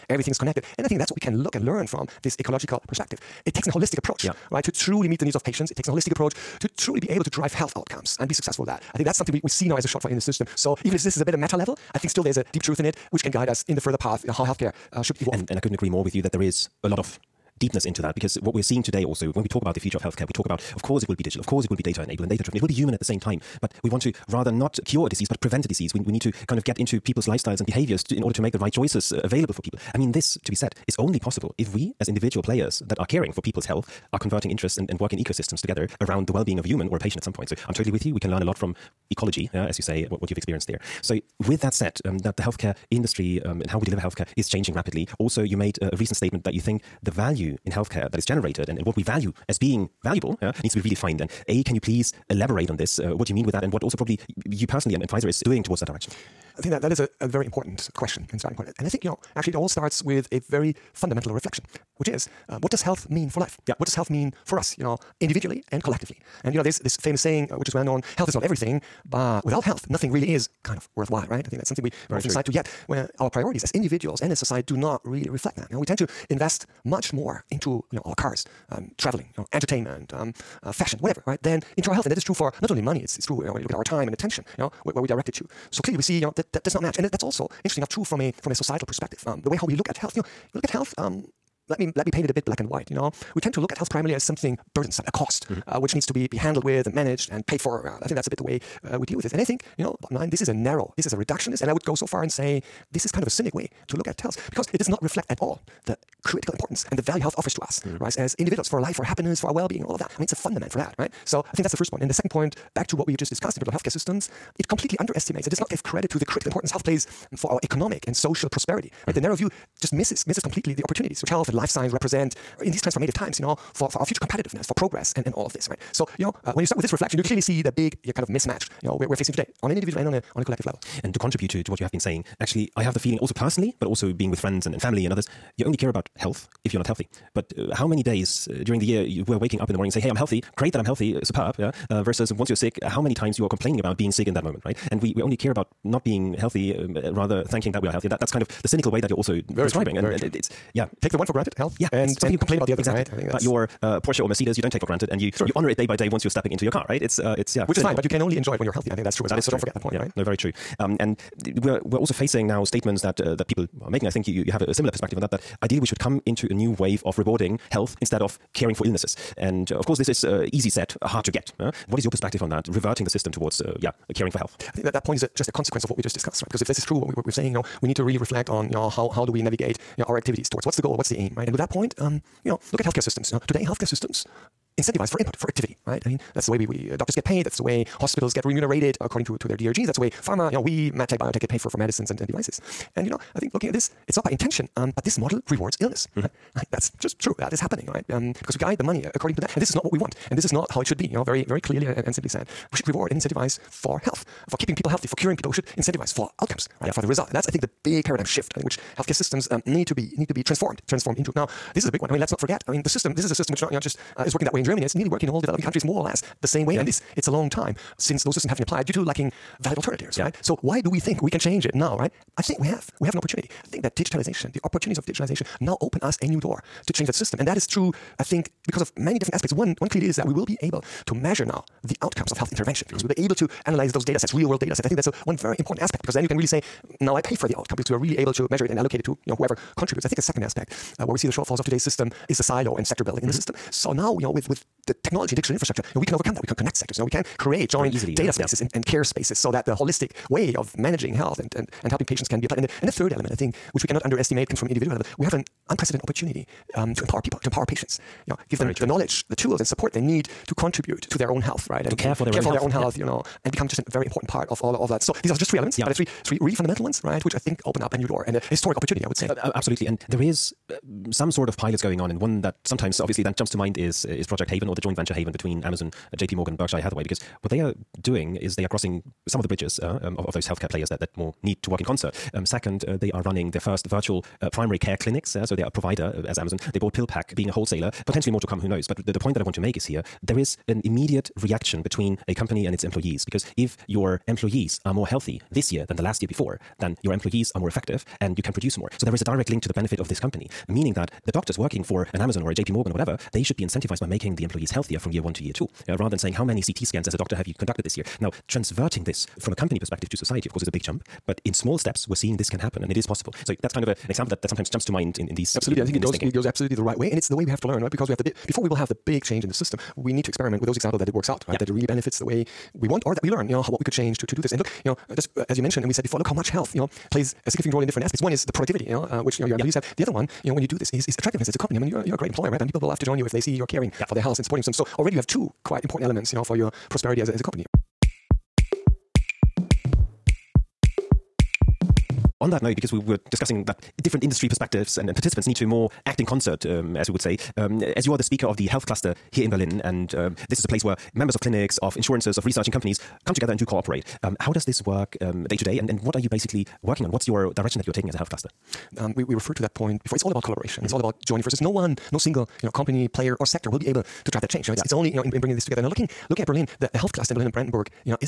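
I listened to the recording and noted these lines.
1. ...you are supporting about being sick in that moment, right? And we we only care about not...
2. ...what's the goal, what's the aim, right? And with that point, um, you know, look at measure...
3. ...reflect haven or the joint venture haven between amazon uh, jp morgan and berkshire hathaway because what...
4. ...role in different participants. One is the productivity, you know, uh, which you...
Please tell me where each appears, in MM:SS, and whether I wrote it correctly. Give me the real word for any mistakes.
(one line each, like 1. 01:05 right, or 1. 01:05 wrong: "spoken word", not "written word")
1. 02:23 wrong: "complaining", not "supporting"
2. 03:00 wrong: "healthcare", not "measure"
3. 04:34 wrong: "project", not "reflect"
4. 05:27 wrong: "aspects", not "participants".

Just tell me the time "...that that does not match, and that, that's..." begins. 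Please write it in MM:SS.
01:26.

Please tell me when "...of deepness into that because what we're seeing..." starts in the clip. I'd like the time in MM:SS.
00:16.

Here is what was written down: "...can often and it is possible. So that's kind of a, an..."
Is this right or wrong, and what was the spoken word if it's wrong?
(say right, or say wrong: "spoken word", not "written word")
wrong: "happen", not "often".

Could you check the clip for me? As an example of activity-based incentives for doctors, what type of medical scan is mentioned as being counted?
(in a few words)
CT scans.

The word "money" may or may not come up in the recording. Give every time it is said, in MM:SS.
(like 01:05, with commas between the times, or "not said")
01:22, 03:18.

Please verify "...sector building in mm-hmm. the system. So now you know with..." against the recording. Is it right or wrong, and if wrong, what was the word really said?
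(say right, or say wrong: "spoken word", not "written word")
right.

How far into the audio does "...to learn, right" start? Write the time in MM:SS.
05:17.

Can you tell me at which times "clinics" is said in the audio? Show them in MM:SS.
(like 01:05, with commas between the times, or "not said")
04:44, 05:51.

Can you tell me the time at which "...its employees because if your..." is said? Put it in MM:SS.
04:52.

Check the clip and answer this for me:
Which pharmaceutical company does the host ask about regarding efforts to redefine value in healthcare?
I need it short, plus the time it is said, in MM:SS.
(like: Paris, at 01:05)
Pfizer, at 00:55.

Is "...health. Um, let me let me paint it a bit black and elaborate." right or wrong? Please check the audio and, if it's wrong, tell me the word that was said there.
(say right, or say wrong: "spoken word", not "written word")
wrong: "white", not "elaborate".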